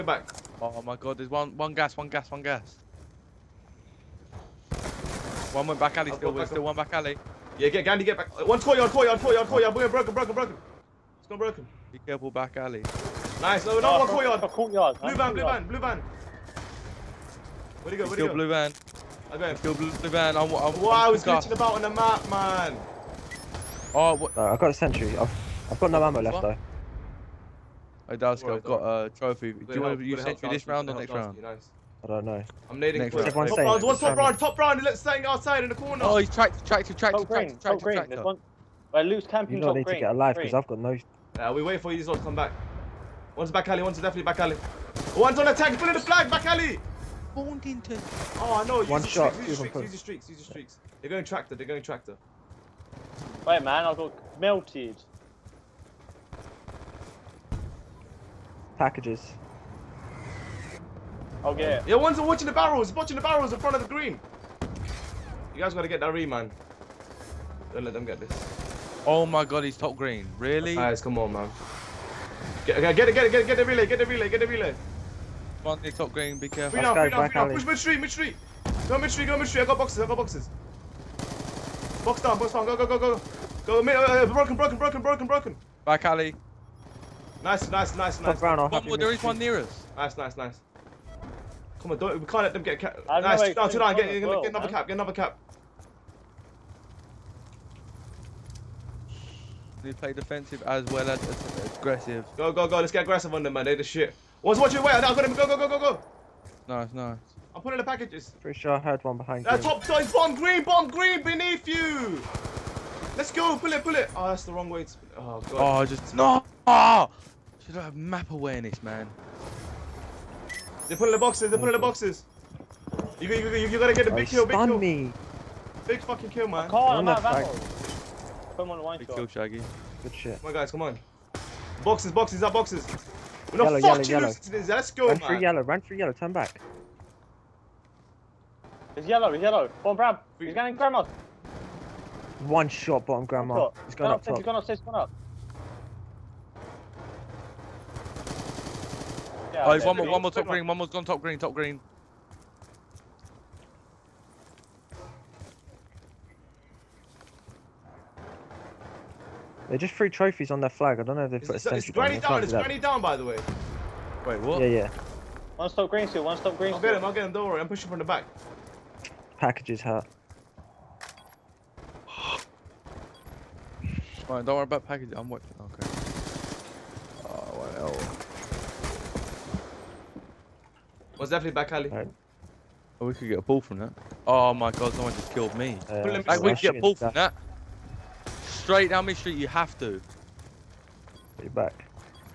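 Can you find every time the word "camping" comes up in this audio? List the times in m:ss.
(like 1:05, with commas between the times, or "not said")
0:39.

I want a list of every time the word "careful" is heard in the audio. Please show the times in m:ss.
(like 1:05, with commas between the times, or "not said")
0:12, 1:16.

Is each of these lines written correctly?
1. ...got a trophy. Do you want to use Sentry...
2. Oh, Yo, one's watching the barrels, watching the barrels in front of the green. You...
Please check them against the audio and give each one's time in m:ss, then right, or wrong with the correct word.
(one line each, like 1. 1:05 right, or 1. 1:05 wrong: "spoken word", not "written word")
1. 0:28 right
2. 1:01 right.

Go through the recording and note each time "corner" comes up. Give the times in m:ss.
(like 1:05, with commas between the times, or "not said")
0:35.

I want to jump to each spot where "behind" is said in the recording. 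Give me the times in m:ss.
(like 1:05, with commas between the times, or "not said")
1:49.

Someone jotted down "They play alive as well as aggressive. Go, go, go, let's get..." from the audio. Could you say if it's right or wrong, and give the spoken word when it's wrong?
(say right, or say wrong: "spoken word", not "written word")
wrong: "defensive", not "alive".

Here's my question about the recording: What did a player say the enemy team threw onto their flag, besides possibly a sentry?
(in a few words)
Trophies.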